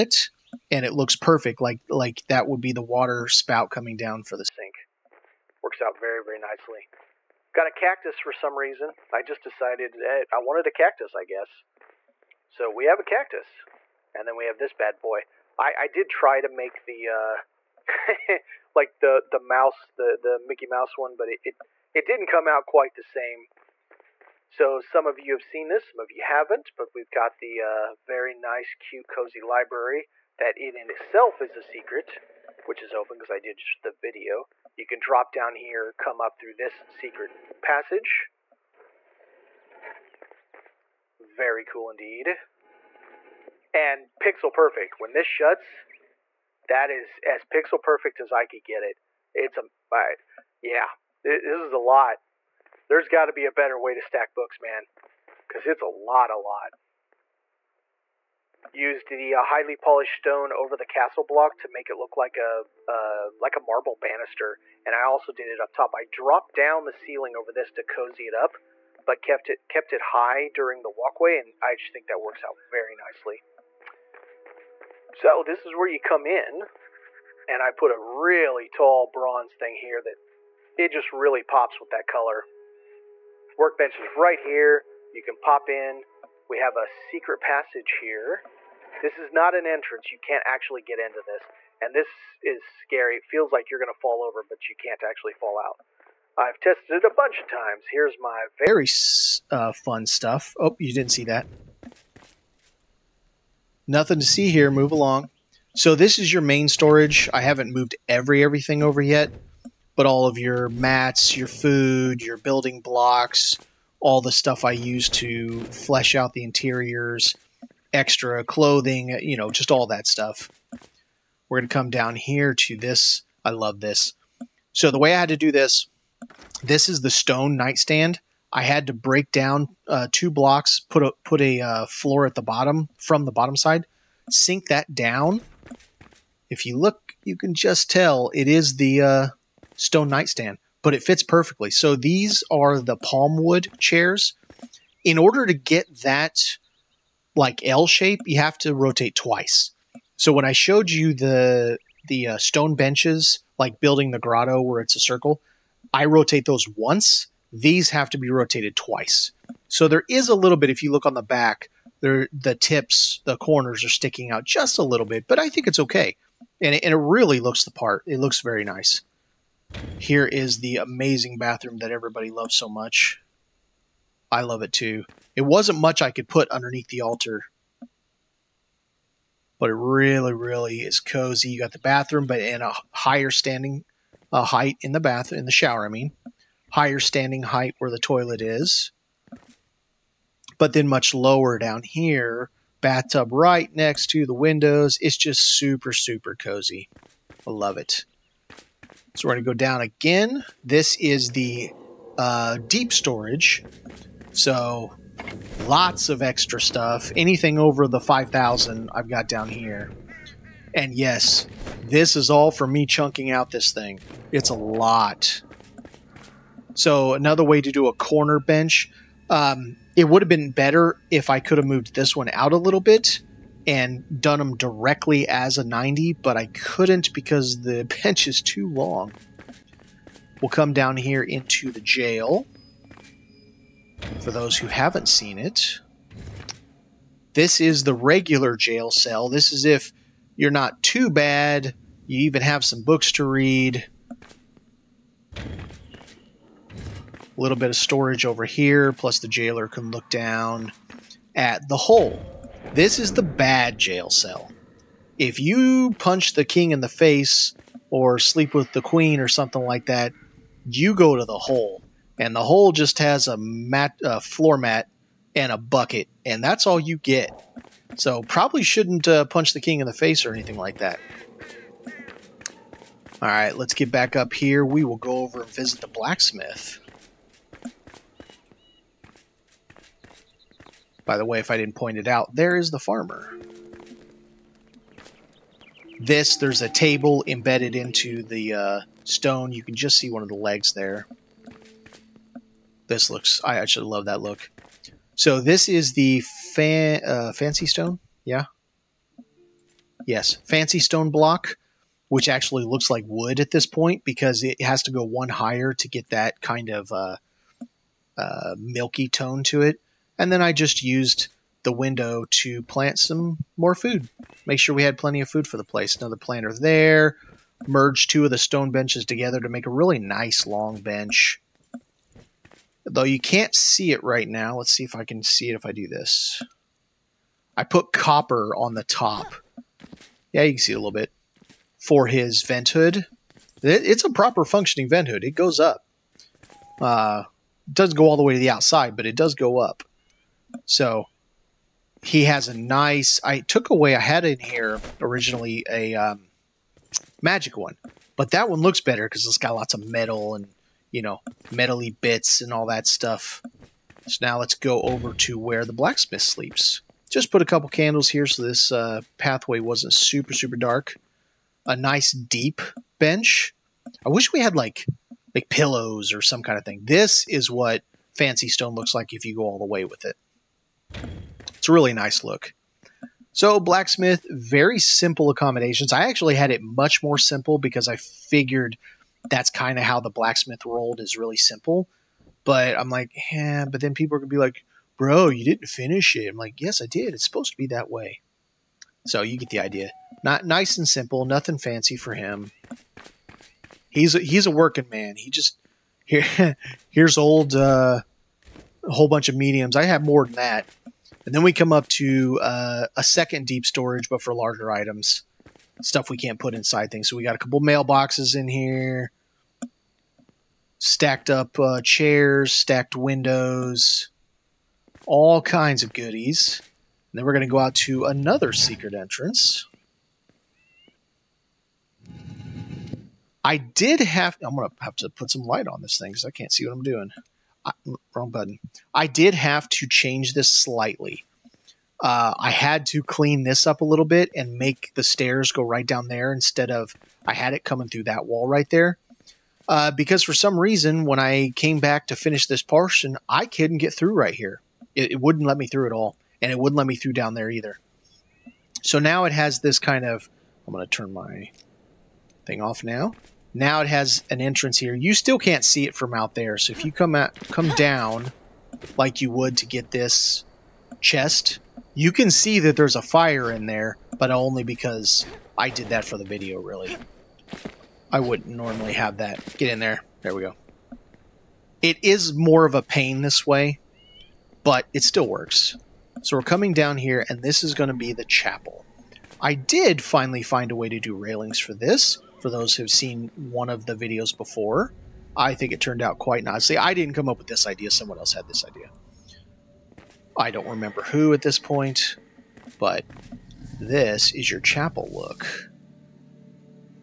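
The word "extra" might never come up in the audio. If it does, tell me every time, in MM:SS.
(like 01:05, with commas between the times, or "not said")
01:57, 03:26.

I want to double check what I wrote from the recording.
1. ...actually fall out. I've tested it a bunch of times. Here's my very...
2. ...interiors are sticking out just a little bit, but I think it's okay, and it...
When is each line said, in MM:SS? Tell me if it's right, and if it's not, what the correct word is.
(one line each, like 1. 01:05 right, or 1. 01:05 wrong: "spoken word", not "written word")
1. 01:35 right
2. 02:43 wrong: "corners", not "interiors".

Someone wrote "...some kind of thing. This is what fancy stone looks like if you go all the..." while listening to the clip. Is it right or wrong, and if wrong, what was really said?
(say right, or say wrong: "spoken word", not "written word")
right.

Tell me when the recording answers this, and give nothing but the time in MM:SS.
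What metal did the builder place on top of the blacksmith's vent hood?
05:27.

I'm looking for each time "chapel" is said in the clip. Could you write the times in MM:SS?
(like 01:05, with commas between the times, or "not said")
07:58, 08:14.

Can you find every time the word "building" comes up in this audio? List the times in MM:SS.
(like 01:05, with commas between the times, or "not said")
01:52, 02:33.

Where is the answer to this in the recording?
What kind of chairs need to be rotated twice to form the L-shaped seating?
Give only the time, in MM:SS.
02:22.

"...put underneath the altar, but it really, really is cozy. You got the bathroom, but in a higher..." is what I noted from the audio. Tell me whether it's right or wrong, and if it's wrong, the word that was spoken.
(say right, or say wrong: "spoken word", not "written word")
right.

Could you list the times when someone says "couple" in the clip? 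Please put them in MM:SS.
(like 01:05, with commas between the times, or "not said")
05:57, 06:47.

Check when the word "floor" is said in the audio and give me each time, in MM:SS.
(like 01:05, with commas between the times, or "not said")
02:11, 04:24.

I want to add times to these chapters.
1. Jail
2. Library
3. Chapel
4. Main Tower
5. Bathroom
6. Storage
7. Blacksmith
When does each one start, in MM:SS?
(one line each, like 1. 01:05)
1. 03:49
2. 00:22
3. 07:02
4. 01:14
5. 01:59
6. 06:32
7. 04:53.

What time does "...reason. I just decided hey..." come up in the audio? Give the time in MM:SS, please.
00:08.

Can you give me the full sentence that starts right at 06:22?
But I'm like, yeah, but then people are going to be like, bro, you didn't finish it.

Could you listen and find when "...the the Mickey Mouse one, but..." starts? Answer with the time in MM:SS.
00:19.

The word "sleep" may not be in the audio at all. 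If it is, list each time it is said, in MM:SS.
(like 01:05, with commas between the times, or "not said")
04:18, 05:56.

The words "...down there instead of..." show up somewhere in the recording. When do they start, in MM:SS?
07:15.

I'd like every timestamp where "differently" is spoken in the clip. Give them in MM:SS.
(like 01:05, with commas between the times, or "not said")
not said.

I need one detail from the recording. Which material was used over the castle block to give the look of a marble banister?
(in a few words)
Highly polished stone.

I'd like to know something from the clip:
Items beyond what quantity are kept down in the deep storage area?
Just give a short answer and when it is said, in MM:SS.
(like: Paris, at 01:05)
5,000, at 03:27.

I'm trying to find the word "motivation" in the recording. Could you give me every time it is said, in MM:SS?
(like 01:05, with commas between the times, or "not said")
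not said.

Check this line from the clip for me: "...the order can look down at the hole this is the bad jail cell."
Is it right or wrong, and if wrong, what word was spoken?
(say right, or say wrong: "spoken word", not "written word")
wrong: "jailer", not "order".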